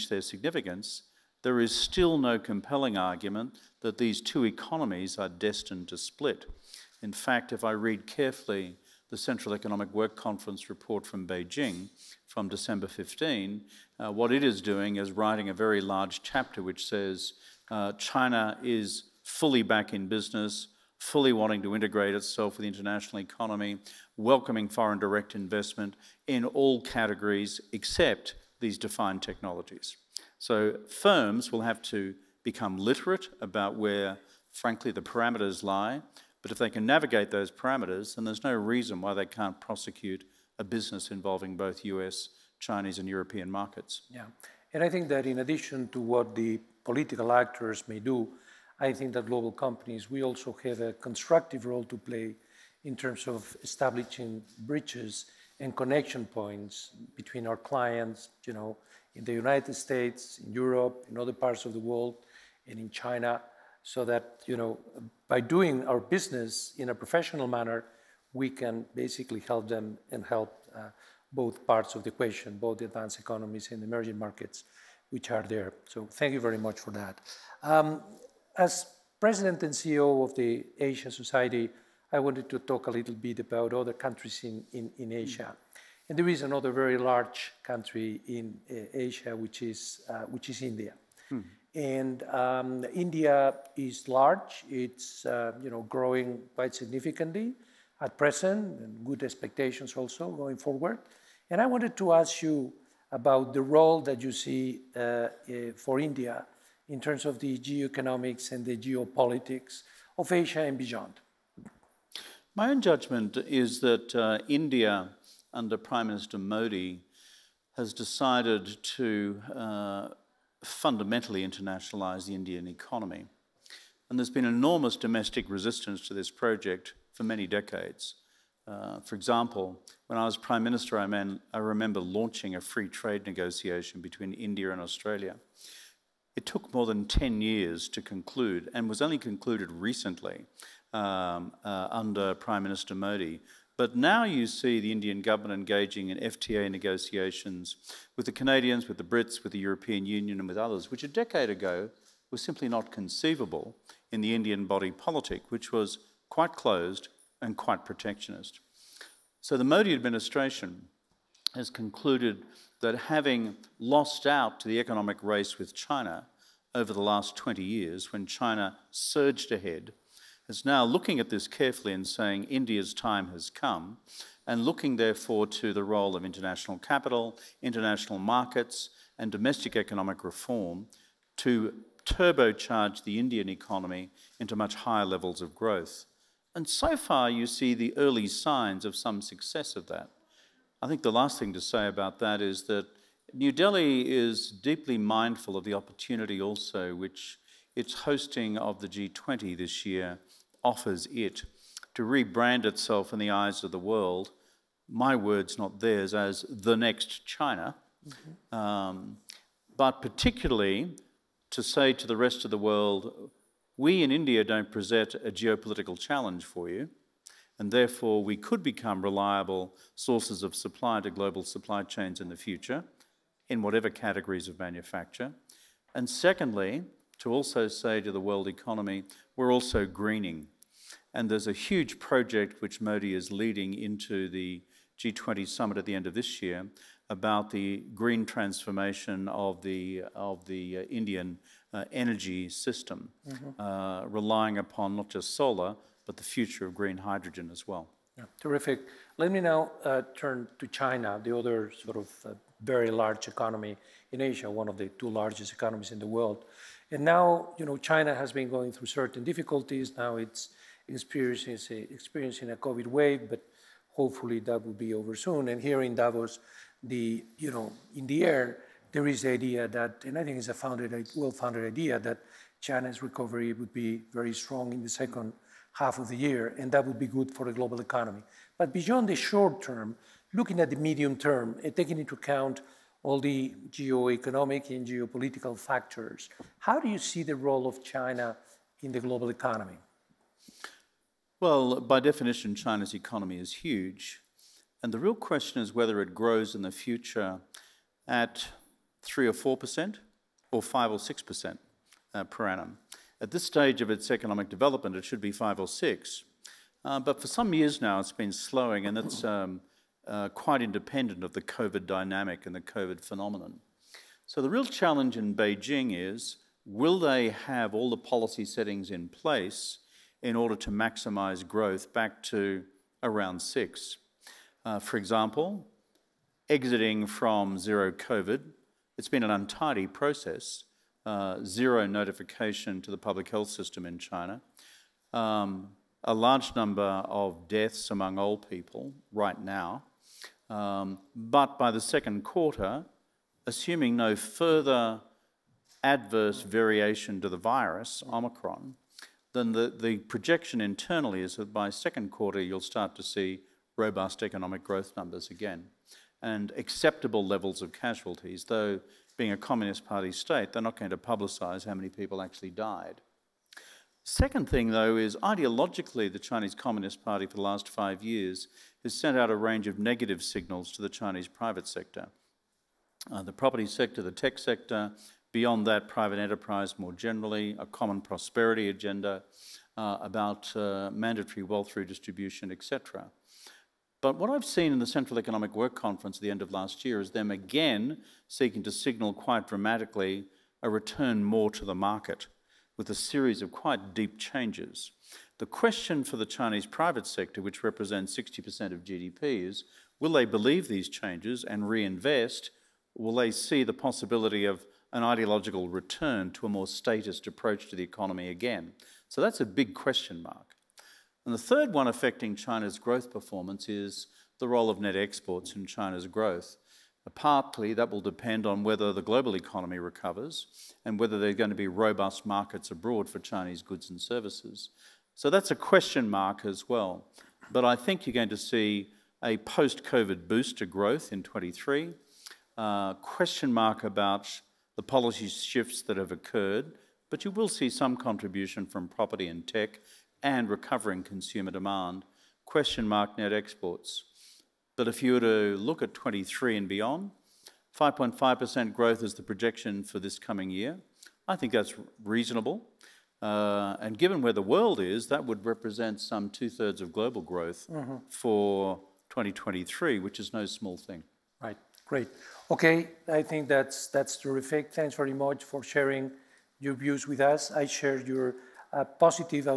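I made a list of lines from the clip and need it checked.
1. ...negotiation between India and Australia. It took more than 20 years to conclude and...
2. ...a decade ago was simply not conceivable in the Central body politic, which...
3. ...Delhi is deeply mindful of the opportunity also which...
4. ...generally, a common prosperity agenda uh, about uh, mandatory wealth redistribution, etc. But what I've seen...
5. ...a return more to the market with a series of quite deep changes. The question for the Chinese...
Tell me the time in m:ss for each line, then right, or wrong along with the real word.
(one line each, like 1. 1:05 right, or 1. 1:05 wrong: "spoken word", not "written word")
1. 2:13 wrong: "10", not "20"
2. 2:31 wrong: "Indian", not "Central"
3. 3:13 right
4. 6:16 right
5. 6:30 right.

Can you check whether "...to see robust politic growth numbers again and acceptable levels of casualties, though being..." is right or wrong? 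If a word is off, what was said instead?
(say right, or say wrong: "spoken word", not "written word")
wrong: "economic", not "politic".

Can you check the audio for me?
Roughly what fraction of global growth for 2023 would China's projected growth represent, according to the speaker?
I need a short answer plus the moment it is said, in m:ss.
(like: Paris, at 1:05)
two thirds, at 7:36.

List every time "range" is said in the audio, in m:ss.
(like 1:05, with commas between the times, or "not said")
6:09.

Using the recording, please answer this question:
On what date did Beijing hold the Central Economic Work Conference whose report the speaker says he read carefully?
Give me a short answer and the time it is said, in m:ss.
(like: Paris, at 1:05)
December 15, at 0:12.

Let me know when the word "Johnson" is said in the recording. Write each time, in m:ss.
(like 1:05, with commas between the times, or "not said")
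not said.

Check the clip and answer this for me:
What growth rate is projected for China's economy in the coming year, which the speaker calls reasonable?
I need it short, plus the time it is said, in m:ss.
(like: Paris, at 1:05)
5.5%, at 7:27.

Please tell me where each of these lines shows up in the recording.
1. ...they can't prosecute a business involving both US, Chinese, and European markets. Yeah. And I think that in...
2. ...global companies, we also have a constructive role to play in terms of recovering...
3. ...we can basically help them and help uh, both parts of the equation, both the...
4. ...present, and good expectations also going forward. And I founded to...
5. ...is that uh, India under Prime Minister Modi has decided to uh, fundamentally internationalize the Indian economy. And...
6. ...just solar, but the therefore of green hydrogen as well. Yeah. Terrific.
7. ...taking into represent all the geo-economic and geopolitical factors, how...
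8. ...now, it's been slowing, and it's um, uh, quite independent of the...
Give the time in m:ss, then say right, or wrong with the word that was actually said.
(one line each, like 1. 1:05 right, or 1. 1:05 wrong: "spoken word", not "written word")
1. 0:39 right
2. 0:49 wrong: "establishing", not "recovering"
3. 1:08 right
4. 1:38 wrong: "wanted", not "founded"
5. 1:53 right
6. 4:05 wrong: "future", not "therefore"
7. 4:41 wrong: "account", not "represent"
8. 5:07 right.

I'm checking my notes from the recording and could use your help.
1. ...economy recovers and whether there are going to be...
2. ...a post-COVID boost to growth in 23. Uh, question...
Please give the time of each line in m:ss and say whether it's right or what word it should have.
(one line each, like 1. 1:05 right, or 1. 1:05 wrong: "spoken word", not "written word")
1. 6:59 right
2. 7:09 right.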